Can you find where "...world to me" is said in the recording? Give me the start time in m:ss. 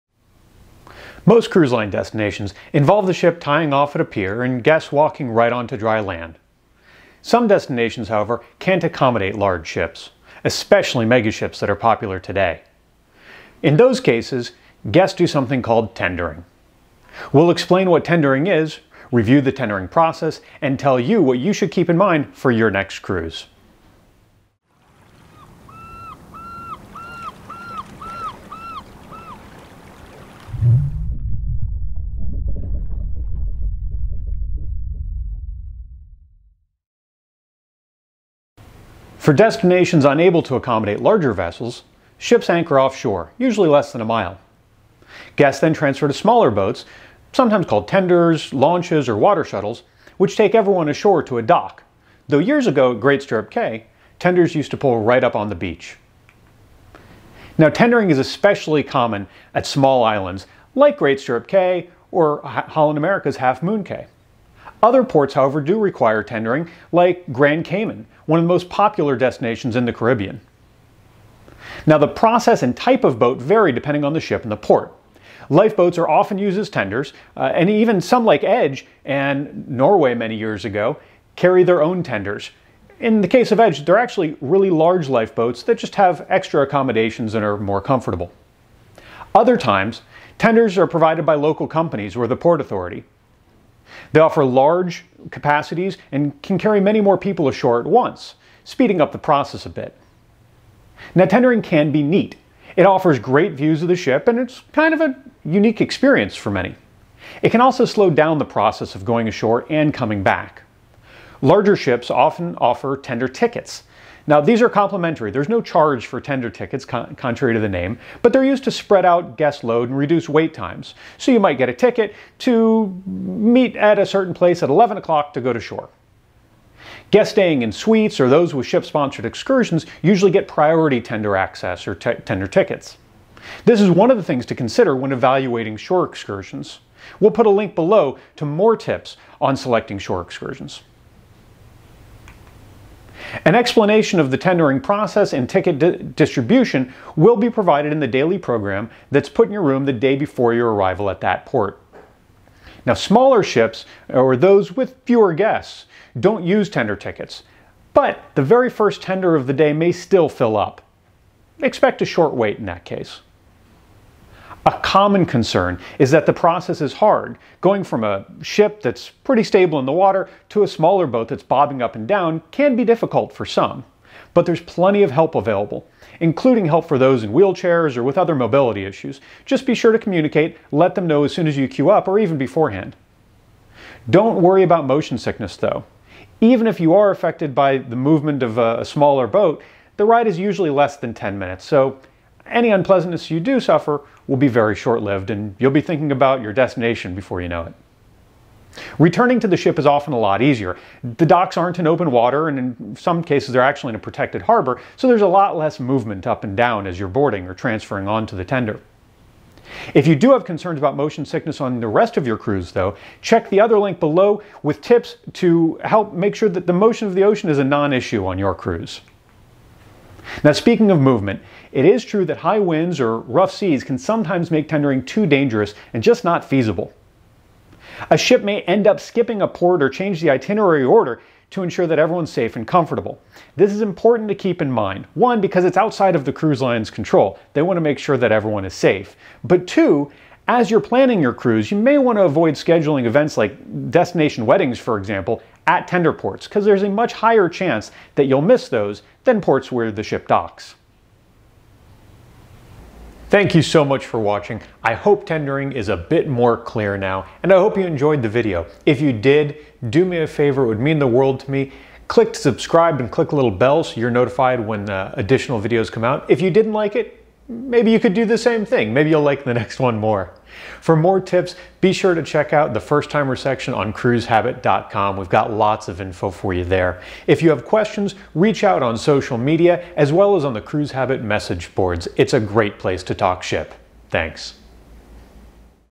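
4:21.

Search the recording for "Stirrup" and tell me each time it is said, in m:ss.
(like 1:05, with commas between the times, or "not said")
0:53, 1:01.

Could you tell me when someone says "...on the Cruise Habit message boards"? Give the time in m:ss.
4:40.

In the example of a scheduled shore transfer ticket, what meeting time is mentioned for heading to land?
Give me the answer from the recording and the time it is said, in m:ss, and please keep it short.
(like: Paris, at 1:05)
11 o'clock, at 2:04.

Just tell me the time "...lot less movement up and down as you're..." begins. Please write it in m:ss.
3:25.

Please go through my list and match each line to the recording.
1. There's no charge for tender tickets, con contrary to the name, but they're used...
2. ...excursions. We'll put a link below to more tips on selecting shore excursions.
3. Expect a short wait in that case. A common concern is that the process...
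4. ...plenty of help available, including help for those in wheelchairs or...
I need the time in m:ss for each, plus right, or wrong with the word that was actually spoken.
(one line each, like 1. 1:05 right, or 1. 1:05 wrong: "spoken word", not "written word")
1. 1:55 right
2. 2:16 right
3. 2:41 right
4. 2:54 right.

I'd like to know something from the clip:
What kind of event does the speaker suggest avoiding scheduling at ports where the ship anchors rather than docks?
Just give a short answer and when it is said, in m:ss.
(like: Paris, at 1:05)
destination weddings, at 4:03.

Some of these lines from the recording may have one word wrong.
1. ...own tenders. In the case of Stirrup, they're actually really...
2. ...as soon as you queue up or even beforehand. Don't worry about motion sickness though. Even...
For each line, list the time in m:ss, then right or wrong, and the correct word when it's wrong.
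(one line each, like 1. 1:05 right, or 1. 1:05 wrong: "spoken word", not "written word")
1. 1:21 wrong: "Edge", not "Stirrup"
2. 3:01 right.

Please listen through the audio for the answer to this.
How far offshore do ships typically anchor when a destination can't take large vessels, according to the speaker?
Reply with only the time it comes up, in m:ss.
0:43.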